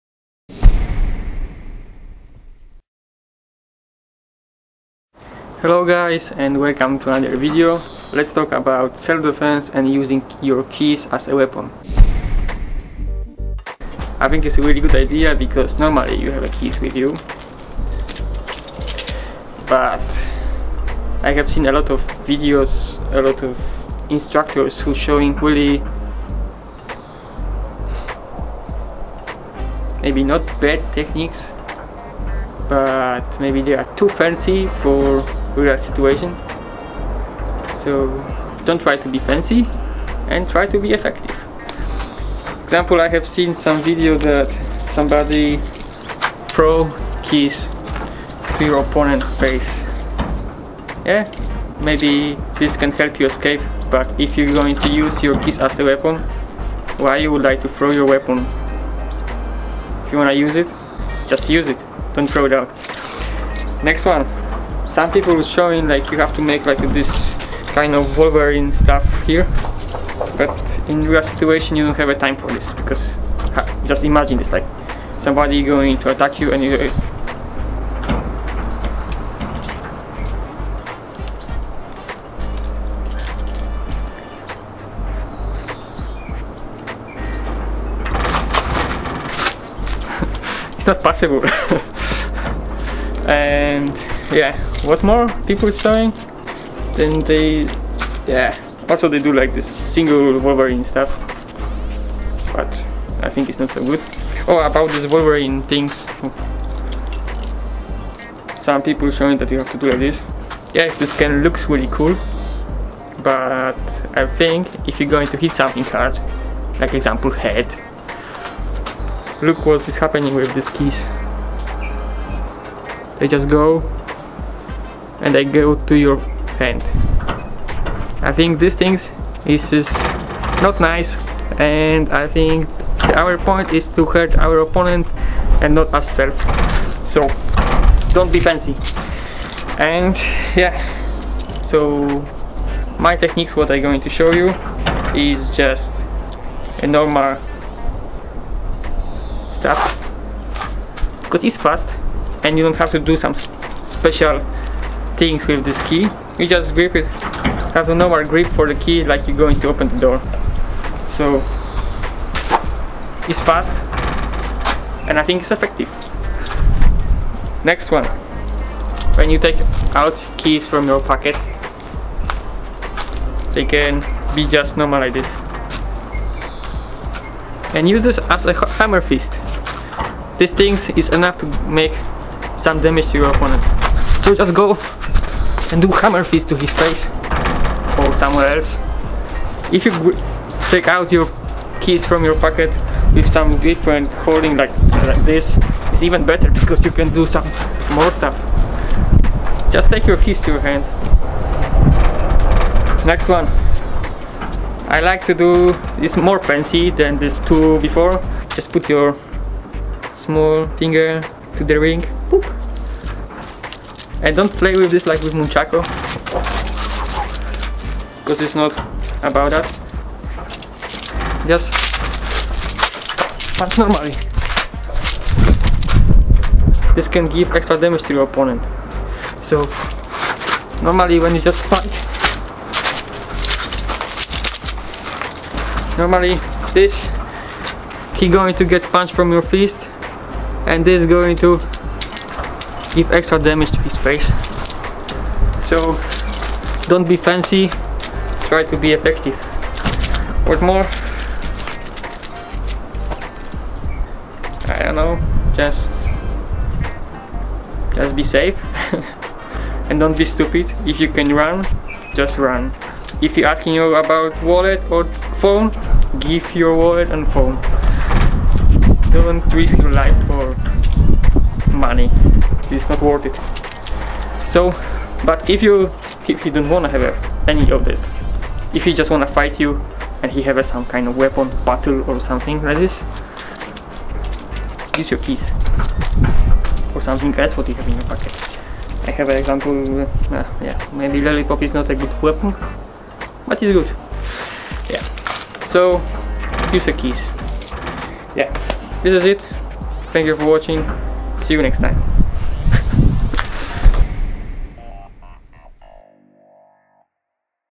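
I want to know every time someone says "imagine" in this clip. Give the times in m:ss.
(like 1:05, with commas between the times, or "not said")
1:14.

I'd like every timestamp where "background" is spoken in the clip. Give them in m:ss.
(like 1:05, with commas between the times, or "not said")
not said.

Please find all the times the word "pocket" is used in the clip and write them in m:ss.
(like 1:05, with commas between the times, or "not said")
2:50, 3:12, 4:48.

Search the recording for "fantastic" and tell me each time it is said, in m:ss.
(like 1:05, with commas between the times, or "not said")
not said.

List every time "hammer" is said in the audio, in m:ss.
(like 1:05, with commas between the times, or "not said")
2:58, 3:05.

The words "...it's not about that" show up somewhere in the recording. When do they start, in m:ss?
3:38.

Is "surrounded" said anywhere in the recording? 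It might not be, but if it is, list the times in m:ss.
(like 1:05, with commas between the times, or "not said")
not said.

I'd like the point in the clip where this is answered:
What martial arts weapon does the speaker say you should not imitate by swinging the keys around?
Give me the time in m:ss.
3:35.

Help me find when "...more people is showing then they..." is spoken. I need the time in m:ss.
1:35.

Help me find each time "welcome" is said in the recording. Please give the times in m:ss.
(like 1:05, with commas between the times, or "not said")
0:06.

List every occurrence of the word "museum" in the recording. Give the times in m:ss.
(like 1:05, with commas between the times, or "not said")
not said.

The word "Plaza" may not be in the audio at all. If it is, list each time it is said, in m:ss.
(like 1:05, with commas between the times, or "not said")
not said.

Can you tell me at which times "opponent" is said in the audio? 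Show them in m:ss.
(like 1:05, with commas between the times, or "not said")
0:48, 2:14, 3:03, 3:48.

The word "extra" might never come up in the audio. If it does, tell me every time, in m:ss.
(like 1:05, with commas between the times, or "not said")
3:47, 4:03.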